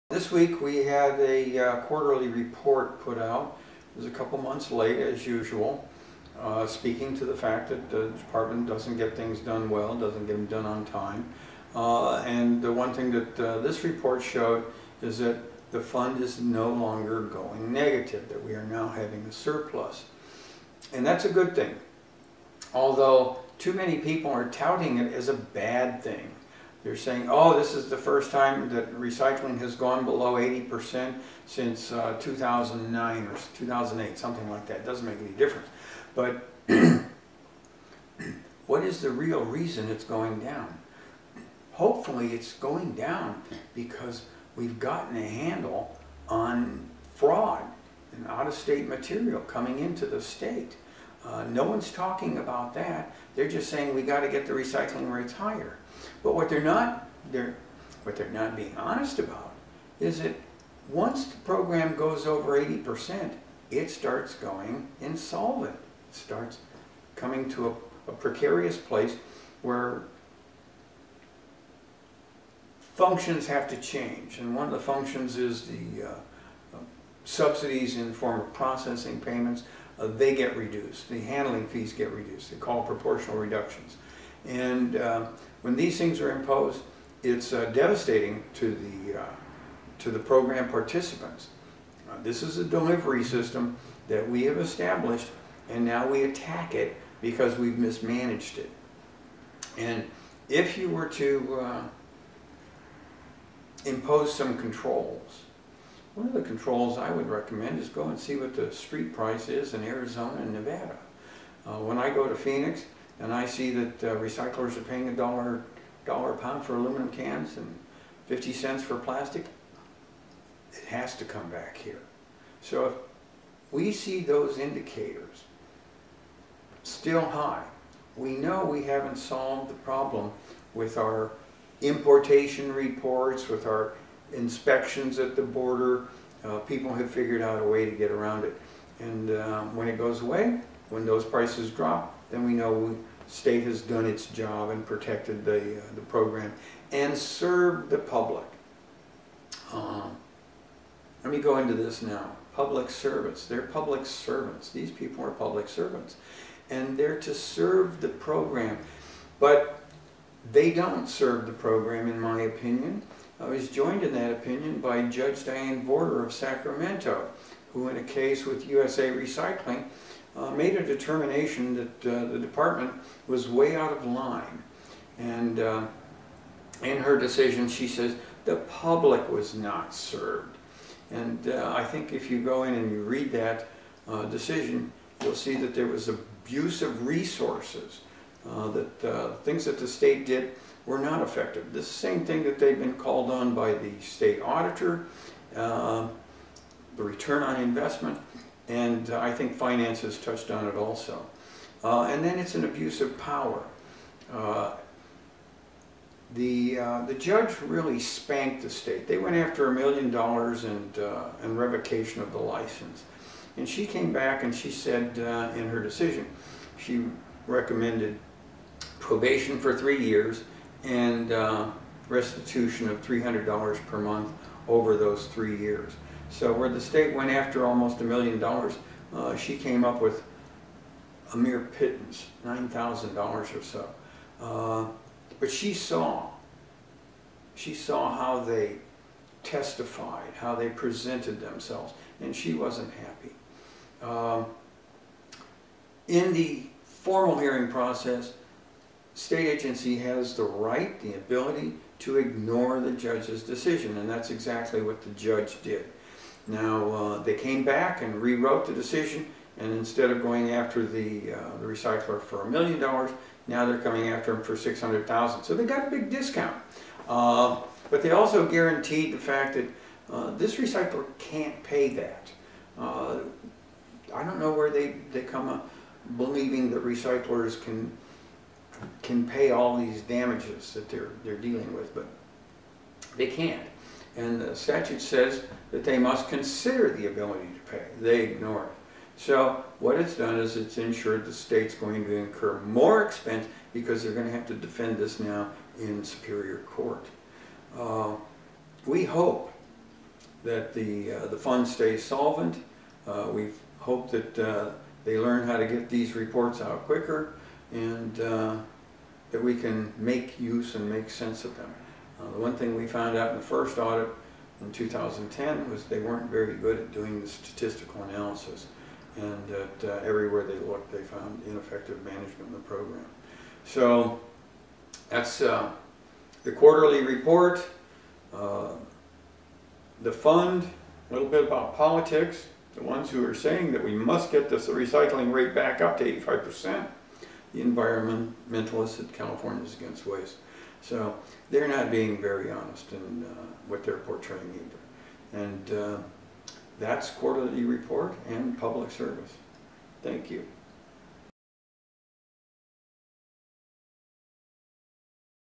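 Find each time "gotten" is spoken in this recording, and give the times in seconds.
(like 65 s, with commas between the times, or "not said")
44 s.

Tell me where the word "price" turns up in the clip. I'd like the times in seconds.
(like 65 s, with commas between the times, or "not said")
109 s, 141 s.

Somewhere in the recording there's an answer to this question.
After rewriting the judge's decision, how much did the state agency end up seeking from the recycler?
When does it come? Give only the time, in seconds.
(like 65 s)
264 s.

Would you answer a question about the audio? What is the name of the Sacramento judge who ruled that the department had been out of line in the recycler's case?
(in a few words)
Diane Vorder.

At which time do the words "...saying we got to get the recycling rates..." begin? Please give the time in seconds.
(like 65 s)
53 s.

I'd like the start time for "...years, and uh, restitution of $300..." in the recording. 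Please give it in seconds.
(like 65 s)
220 s.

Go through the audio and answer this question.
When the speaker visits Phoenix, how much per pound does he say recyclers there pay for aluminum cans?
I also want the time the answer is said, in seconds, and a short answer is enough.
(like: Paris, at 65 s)
$1, at 115 s.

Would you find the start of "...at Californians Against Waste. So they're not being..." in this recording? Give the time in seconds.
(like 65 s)
338 s.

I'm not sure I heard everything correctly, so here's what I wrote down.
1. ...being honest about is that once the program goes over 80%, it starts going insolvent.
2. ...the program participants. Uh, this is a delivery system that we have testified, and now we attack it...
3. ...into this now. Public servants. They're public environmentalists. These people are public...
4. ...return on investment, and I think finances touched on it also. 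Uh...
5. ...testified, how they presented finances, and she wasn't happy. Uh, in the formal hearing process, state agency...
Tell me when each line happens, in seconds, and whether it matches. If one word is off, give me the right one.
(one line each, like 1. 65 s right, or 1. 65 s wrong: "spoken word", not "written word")
1. 58 s right
2. 90 s wrong: "established", not "testified"
3. 151 s wrong: "servants", not "environmentalists"
4. 197 s right
5. 239 s wrong: "themselves", not "finances".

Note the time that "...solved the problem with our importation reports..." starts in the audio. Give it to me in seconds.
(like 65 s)
129 s.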